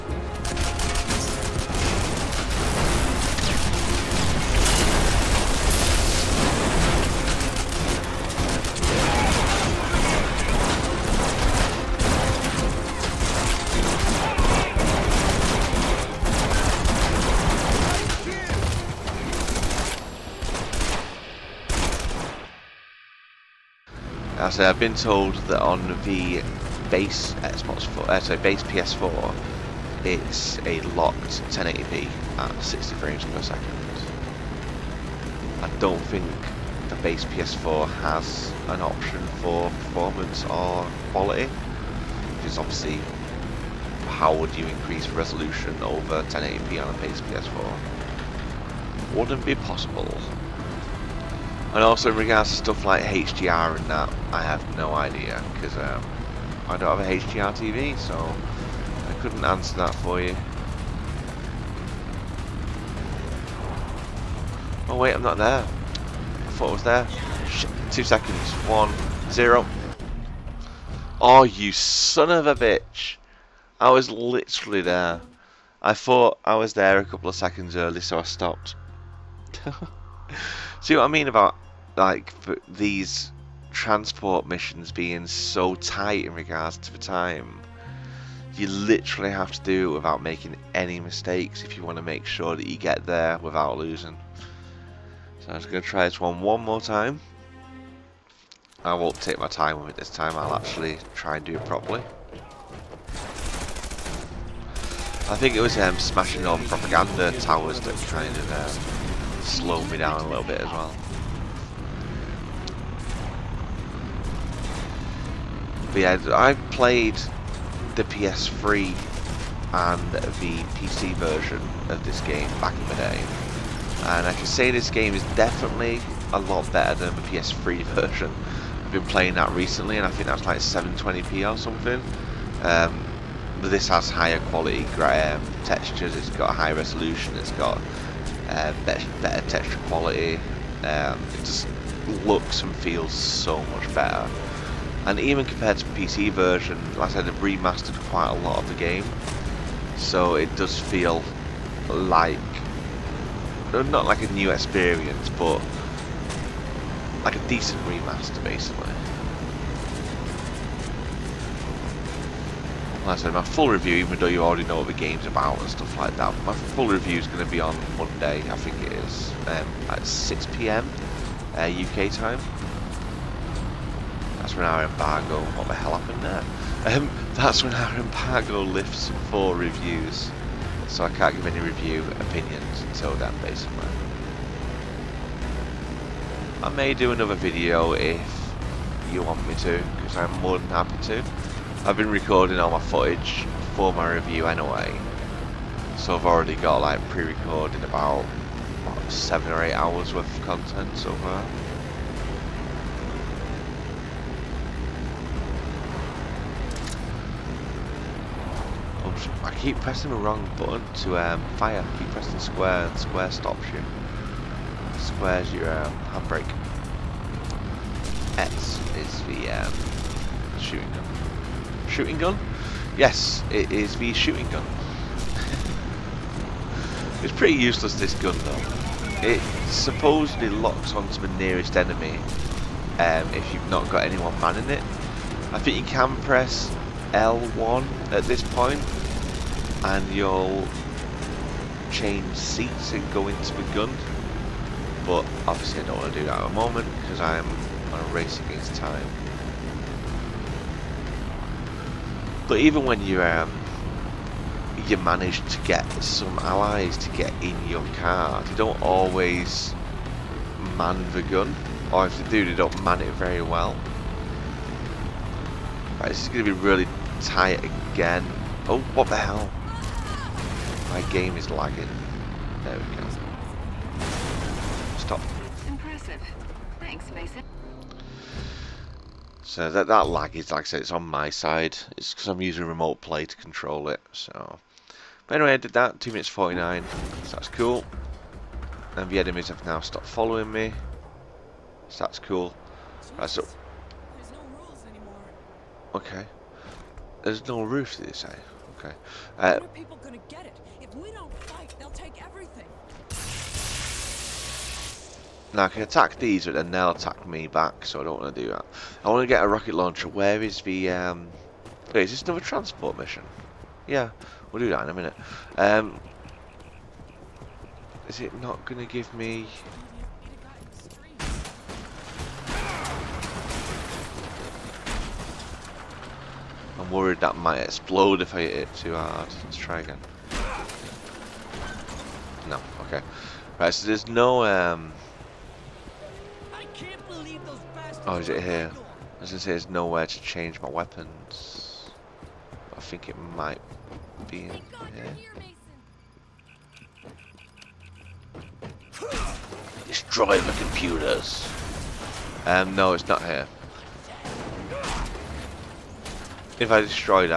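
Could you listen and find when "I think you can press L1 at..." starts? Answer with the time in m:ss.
3:55.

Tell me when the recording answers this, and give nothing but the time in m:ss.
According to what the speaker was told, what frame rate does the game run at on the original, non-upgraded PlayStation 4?
0:32.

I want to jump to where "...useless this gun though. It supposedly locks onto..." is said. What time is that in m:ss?
3:47.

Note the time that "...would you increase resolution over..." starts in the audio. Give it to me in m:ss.
0:44.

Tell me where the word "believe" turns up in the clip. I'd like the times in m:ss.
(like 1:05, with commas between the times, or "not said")
not said.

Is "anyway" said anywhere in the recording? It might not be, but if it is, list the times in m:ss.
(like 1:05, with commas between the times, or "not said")
3:14, 4:45.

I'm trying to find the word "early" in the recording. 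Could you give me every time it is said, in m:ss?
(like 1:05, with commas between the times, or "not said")
1:17.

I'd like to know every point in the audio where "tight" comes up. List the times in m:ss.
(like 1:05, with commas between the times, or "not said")
1:25, 4:27.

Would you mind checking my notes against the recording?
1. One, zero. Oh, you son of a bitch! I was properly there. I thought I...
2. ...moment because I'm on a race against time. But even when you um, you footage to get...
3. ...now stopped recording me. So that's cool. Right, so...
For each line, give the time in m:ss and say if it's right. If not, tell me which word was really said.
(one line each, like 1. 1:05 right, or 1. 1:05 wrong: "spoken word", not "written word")
1. 1:08 wrong: "literally", not "properly"
2. 4:06 wrong: "manage", not "footage"
3. 4:49 wrong: "following", not "recording".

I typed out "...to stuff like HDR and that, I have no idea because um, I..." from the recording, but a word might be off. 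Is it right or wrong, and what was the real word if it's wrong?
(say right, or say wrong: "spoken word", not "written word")
right.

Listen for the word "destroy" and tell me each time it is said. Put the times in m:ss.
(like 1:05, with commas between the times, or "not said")
5:49, 5:56.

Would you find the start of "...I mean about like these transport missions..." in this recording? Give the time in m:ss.
1:21.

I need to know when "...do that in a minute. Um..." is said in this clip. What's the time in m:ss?
5:14.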